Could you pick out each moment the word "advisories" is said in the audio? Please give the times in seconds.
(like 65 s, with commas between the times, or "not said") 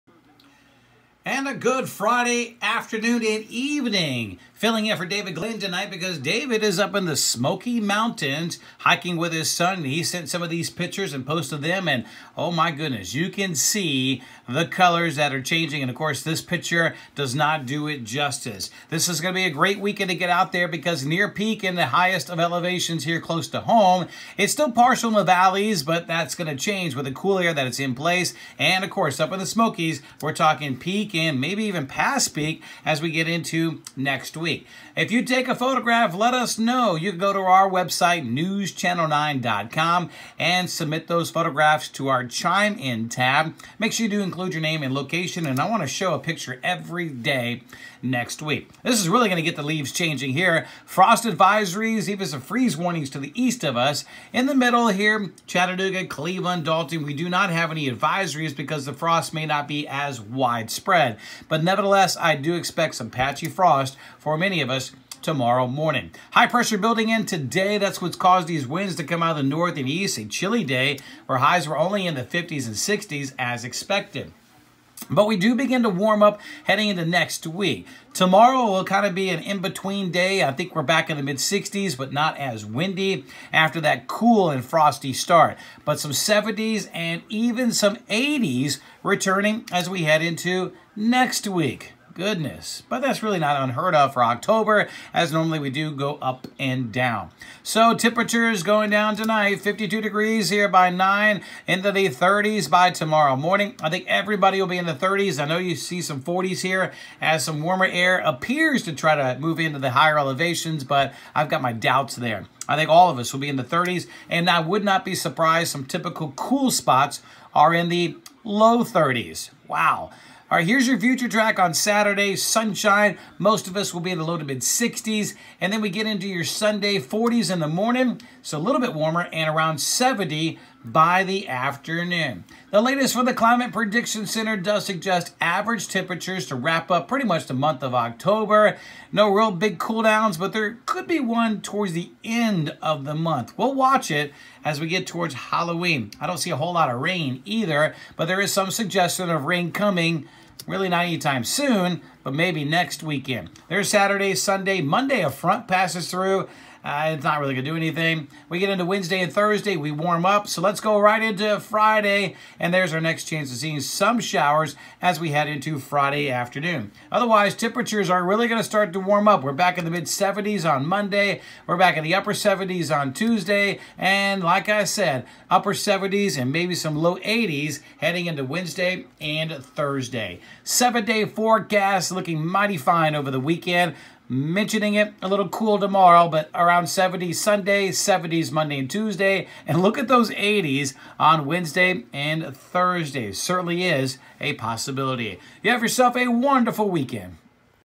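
51 s, 57 s.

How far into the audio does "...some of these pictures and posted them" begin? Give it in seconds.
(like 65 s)
10 s.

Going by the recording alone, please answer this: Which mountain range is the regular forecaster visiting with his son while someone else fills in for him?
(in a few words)
Smoky Mountains.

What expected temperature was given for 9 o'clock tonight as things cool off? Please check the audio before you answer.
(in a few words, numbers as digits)
52 degrees.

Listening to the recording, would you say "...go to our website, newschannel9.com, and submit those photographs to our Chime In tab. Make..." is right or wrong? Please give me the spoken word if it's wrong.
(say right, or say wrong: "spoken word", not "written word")
right.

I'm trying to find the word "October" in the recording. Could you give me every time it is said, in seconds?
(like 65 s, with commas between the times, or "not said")
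94 s, 137 s.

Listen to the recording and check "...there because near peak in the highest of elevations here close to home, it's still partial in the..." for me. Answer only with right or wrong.
right.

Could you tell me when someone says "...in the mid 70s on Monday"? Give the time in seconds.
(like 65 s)
169 s.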